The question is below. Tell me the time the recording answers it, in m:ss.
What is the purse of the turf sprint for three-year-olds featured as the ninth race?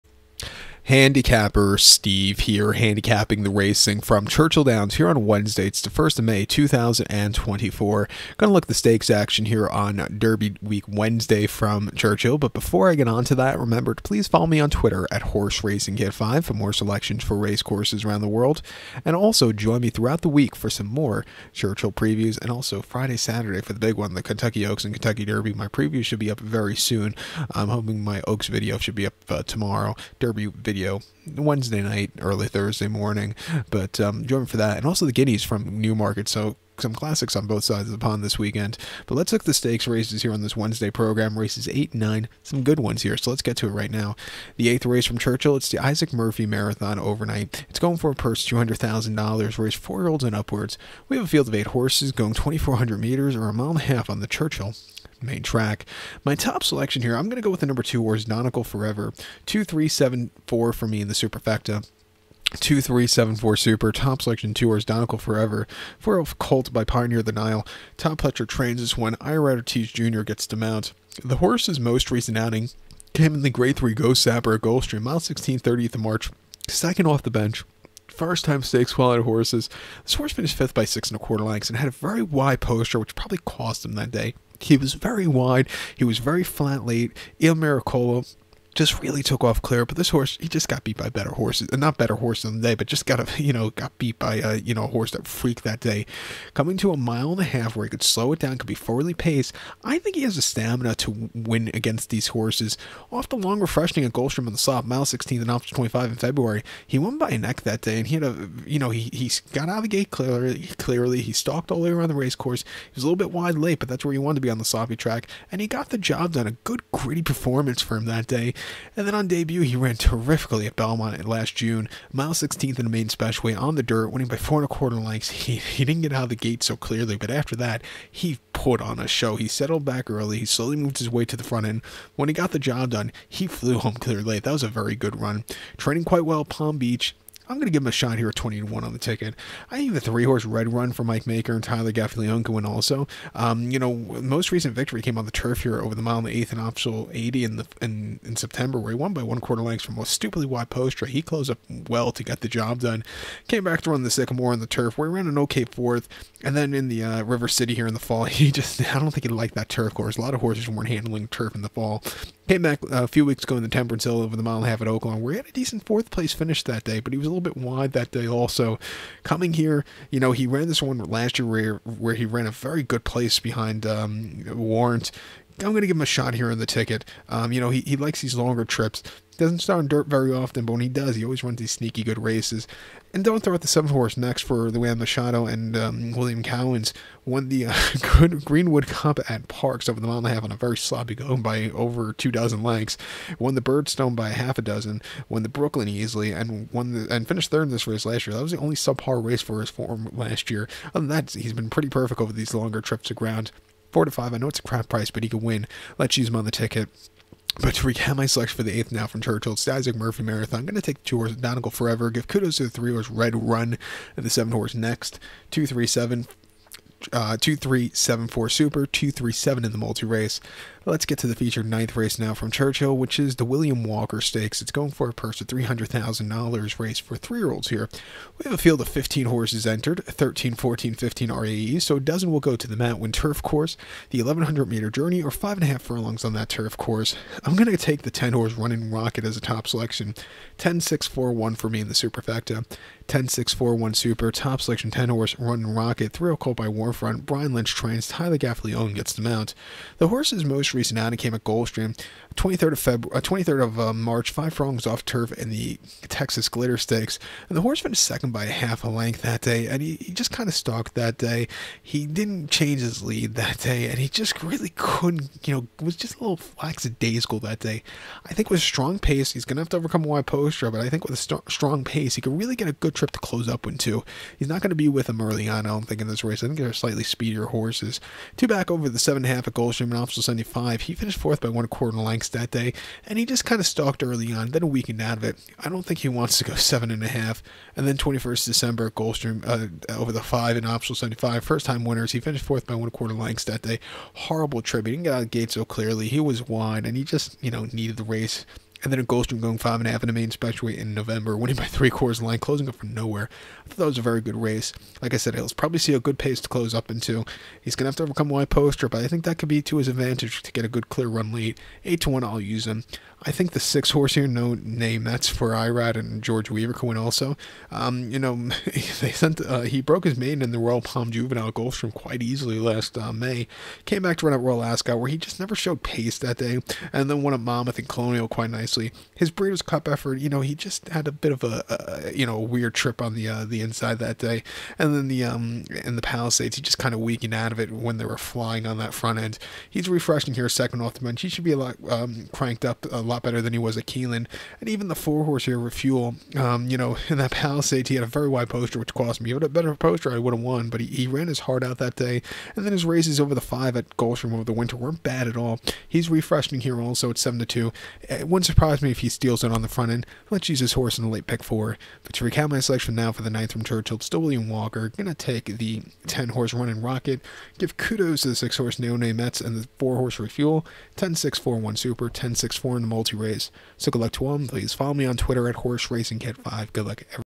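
3:45.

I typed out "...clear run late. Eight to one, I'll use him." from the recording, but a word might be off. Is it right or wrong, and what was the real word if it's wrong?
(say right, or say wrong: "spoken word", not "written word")
right.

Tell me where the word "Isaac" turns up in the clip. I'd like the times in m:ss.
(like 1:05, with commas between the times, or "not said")
0:45, 3:29.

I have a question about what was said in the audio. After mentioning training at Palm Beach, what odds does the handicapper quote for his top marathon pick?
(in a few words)
20 to 1.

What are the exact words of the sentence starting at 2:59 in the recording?
Doesn't start on dirt very often, but when he does, he always runs these sneaky good races.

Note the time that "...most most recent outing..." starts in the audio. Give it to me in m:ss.
4:10.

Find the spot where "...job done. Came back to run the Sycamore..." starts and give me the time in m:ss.
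2:32.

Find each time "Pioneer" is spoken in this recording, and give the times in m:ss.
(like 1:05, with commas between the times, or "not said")
1:06.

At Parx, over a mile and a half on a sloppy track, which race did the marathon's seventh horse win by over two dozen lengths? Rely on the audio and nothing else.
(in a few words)
Greenwood Cup.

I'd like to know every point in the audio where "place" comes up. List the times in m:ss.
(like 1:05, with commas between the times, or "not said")
2:46, 2:53.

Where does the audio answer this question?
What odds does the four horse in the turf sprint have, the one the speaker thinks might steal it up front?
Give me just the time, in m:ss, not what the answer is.
5:57.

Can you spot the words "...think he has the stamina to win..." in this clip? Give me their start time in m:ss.
1:39.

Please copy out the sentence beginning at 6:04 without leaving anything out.
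Gonna take the 10 horse running rocket.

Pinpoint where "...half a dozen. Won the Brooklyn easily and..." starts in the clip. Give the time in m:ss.
3:14.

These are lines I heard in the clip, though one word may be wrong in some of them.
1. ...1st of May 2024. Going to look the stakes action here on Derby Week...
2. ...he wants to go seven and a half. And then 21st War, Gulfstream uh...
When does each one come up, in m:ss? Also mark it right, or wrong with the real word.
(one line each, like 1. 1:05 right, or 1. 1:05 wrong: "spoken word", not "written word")
1. 0:05 right
2. 4:46 wrong: "December", not "War".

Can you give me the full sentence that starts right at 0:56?
My top selection here, I'm going to go with the number two, Donegal Forever.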